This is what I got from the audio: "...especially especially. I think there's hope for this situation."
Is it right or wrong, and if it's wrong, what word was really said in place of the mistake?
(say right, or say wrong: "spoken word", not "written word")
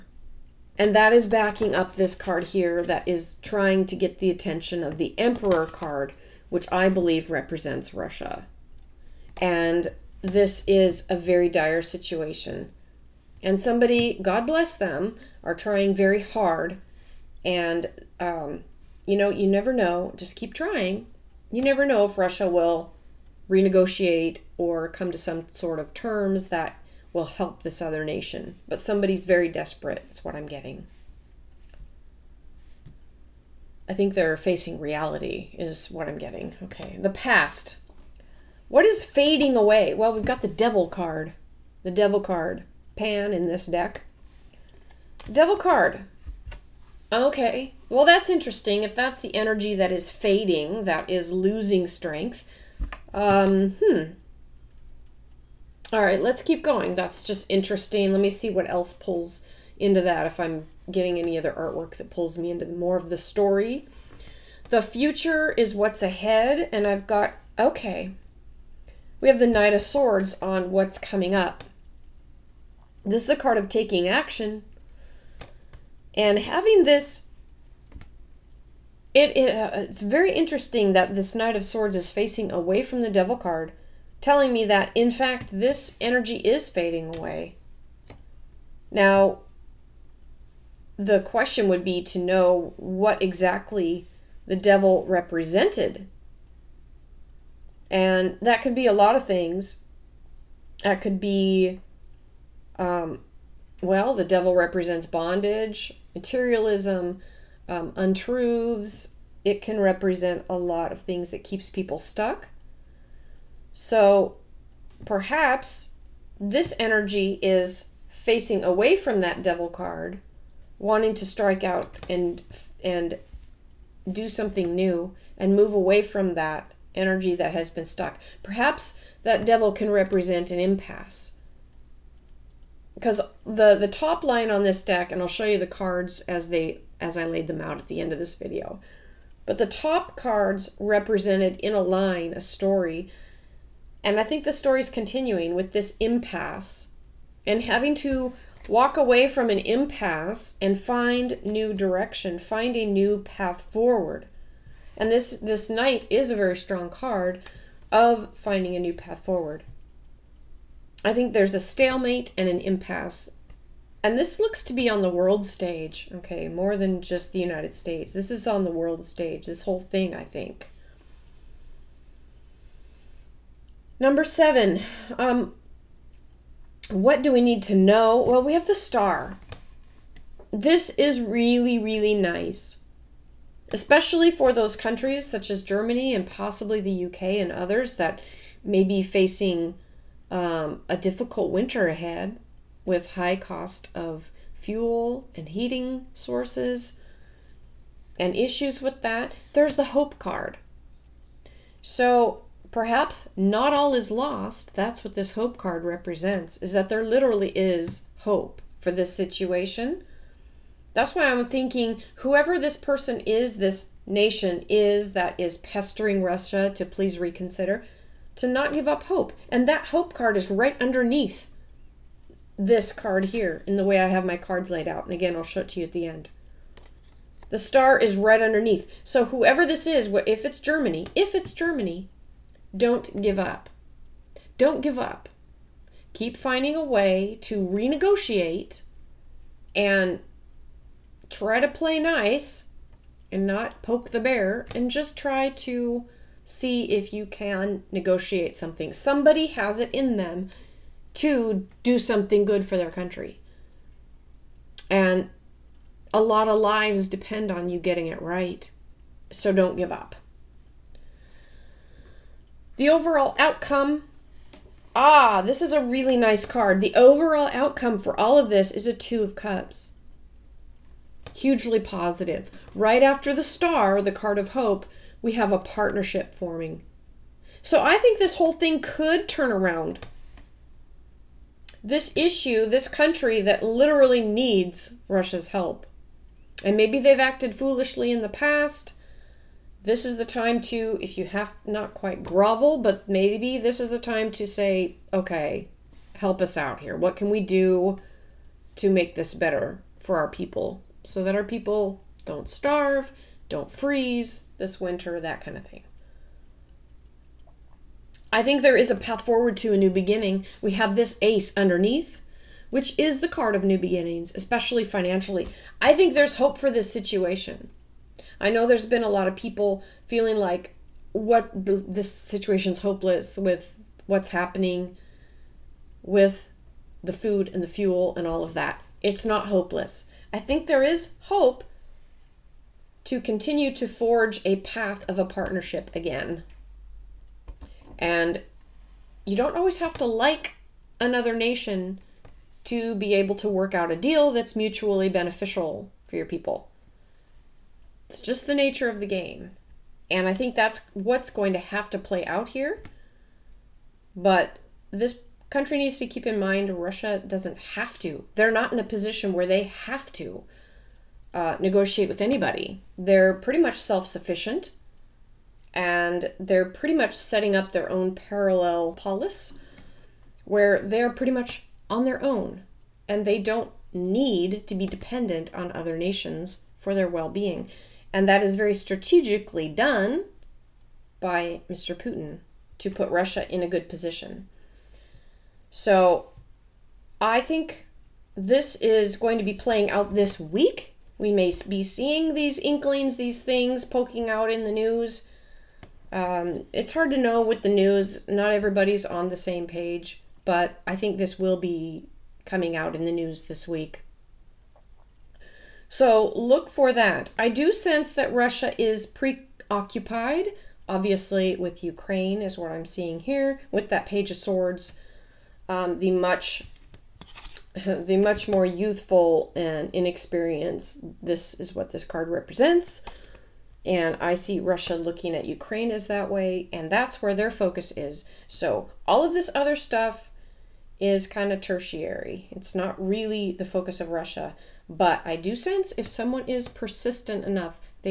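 wrong: "financially", not "especially".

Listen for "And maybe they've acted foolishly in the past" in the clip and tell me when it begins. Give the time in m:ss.
4:46.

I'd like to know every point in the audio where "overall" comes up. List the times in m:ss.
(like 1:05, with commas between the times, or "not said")
4:22, 4:26.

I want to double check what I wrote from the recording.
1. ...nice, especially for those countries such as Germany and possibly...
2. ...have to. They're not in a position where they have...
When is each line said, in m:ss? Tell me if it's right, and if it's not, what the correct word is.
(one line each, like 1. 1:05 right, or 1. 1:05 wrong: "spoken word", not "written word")
1. 3:02 right
2. 5:57 right.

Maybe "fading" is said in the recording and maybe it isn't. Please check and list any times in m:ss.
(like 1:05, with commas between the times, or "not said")
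0:39, 0:50, 1:26.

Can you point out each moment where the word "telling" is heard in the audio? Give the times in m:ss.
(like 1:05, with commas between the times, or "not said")
1:24.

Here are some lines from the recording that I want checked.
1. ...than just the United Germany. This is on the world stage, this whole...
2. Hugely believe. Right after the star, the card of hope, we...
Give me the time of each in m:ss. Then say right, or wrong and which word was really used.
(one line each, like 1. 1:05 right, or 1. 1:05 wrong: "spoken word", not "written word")
1. 2:46 wrong: "States", not "Germany"
2. 4:31 wrong: "positive", not "believe".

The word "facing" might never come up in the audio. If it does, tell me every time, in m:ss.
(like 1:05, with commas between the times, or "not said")
0:34, 1:22, 1:58, 3:09.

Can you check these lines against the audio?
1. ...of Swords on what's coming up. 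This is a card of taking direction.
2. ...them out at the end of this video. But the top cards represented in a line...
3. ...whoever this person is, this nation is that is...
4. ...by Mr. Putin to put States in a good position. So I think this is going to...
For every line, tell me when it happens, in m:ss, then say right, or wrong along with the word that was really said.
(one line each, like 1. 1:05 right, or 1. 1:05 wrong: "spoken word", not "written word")
1. 1:09 wrong: "action", not "direction"
2. 2:17 right
3. 3:32 right
4. 6:21 wrong: "Russia", not "States".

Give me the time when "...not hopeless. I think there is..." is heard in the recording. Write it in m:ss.
5:29.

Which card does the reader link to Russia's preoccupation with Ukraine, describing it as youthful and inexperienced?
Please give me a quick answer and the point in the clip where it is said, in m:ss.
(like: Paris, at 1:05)
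Page of Swords, at 6:54.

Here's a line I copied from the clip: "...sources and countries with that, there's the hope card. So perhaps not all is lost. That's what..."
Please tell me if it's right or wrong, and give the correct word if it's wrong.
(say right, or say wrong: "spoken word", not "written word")
wrong: "issues", not "countries".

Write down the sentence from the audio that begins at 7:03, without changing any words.
And I see Russia looking at Ukraine as that way, and that's where their focus is.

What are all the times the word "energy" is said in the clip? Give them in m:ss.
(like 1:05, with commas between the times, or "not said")
0:49, 1:25, 1:56, 2:06.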